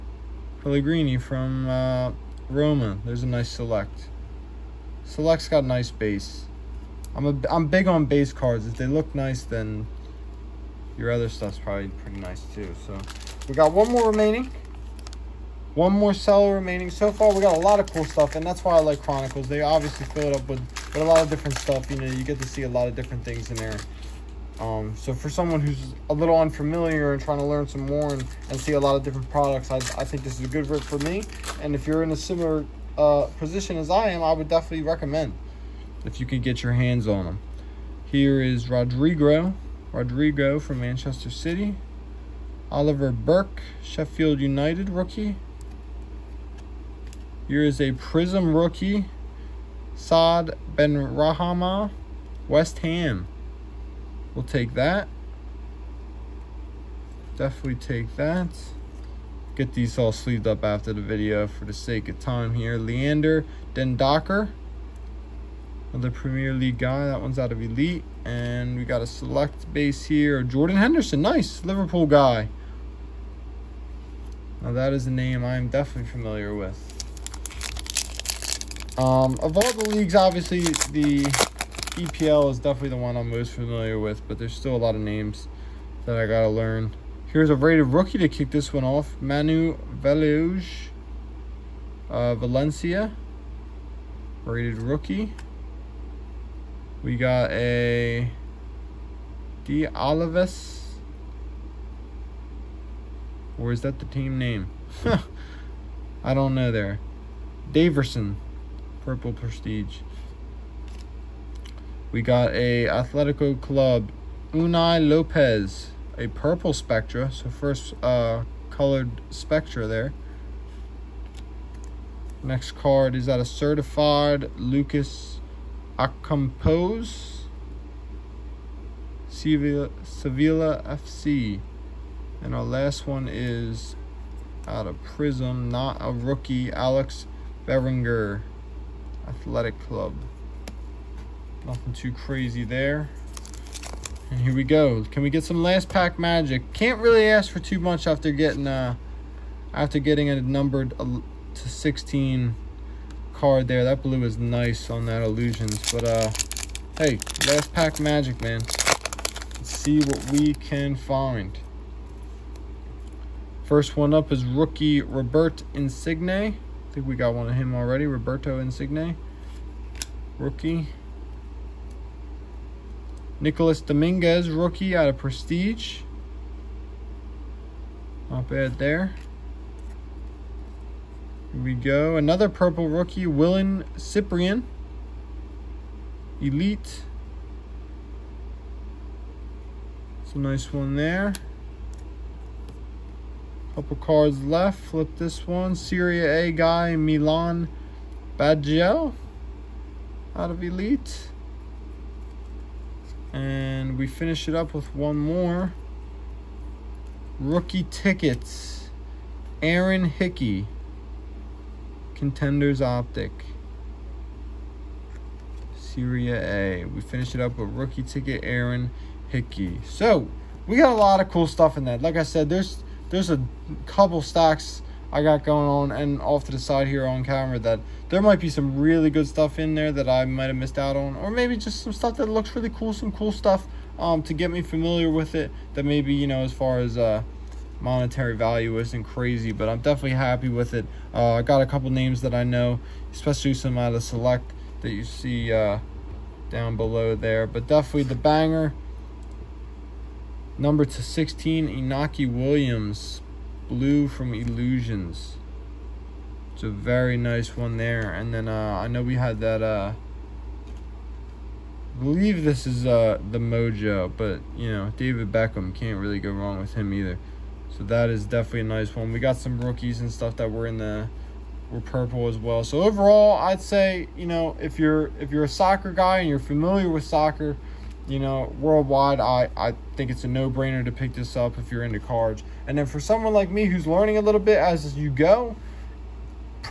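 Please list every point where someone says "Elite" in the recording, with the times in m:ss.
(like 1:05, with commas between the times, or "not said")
1:07, 3:06, 3:20.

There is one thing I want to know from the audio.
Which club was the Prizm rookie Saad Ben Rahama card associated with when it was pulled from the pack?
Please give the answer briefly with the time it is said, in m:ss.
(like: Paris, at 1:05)
West Ham, at 0:52.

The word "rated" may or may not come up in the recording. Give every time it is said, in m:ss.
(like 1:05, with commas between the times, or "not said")
1:27, 1:34.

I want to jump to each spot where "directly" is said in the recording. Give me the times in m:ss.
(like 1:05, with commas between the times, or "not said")
not said.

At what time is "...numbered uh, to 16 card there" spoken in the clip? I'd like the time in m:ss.
2:30.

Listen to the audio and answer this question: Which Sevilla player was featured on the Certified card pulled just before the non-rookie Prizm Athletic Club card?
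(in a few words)
Lucas Acampos.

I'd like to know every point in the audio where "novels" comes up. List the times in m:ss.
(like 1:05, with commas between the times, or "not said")
not said.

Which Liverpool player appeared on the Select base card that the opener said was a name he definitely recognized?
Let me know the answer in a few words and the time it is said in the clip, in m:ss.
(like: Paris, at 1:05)
Jordan Henderson, at 1:10.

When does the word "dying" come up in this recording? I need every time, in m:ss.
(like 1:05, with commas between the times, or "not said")
not said.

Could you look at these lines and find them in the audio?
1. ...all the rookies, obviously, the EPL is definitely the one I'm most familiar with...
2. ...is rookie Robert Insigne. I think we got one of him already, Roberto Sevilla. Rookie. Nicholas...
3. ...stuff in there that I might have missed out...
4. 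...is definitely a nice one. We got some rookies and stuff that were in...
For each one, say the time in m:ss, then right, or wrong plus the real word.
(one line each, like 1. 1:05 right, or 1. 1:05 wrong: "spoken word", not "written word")
1. 1:19 wrong: "leagues", not "rookies"
2. 2:44 wrong: "Insigne", not "Sevilla"
3. 3:49 right
4. 4:28 right.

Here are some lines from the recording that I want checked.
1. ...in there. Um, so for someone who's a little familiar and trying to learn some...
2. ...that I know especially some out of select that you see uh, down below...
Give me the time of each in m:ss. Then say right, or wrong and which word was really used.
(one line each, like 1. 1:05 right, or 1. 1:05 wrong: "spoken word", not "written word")
1. 0:23 wrong: "unfamiliar", not "familiar"
2. 4:02 right.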